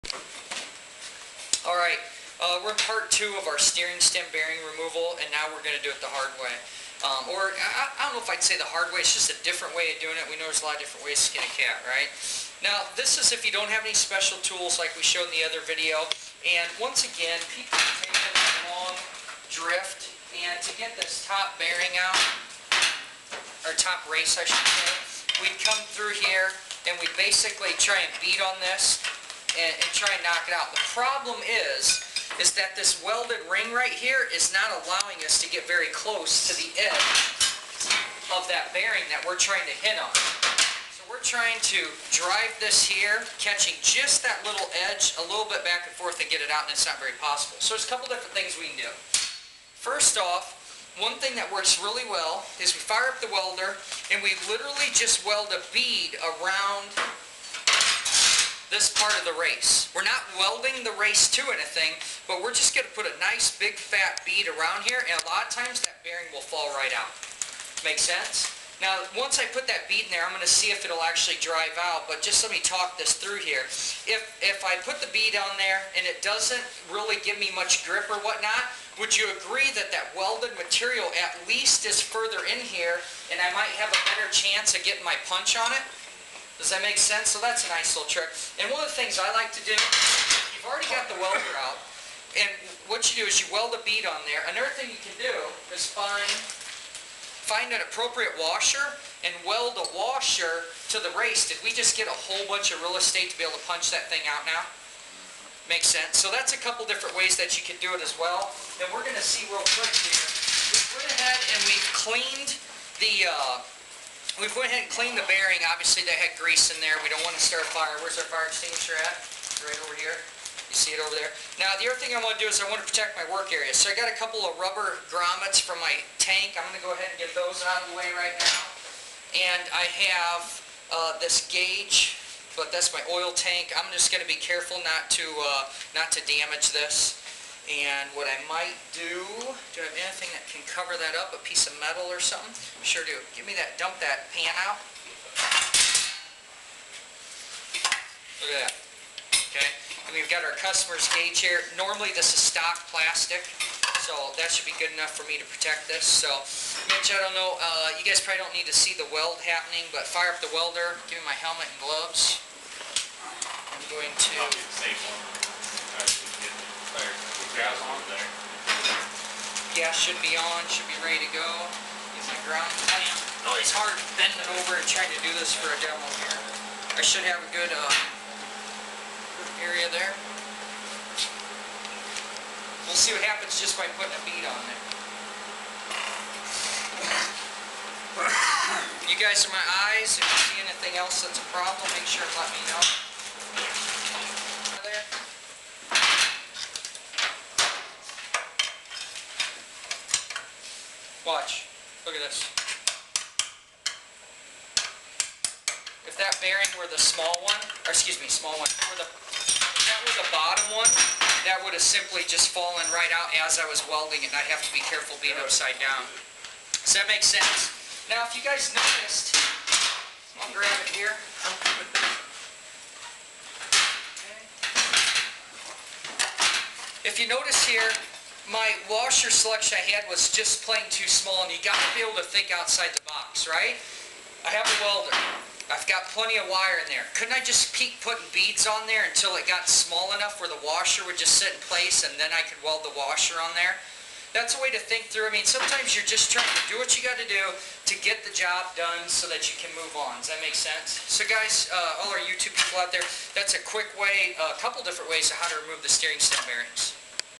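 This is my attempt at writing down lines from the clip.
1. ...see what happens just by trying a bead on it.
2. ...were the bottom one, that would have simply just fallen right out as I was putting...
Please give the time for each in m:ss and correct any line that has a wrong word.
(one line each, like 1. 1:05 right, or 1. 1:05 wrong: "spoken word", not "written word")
1. 3:02 wrong: "putting", not "trying"
2. 3:30 wrong: "welding", not "putting".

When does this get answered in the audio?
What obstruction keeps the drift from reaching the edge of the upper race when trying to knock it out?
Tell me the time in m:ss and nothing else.
0:33.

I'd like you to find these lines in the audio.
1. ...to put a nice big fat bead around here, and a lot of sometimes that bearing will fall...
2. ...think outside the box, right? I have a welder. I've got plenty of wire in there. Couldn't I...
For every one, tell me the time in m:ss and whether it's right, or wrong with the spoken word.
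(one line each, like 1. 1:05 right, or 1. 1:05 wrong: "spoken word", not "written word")
1. 1:02 wrong: "times", not "sometimes"
2. 3:52 right.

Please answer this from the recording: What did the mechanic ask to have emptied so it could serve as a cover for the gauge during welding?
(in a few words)
pan.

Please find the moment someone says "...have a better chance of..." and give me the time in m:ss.
1:23.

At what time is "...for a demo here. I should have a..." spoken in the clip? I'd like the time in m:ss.
2:55.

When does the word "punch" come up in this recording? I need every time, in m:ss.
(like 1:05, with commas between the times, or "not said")
1:25, 1:43.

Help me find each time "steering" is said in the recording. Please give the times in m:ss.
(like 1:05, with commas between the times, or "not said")
0:03, 4:15.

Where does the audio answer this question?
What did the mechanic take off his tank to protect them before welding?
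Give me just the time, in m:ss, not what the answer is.
2:04.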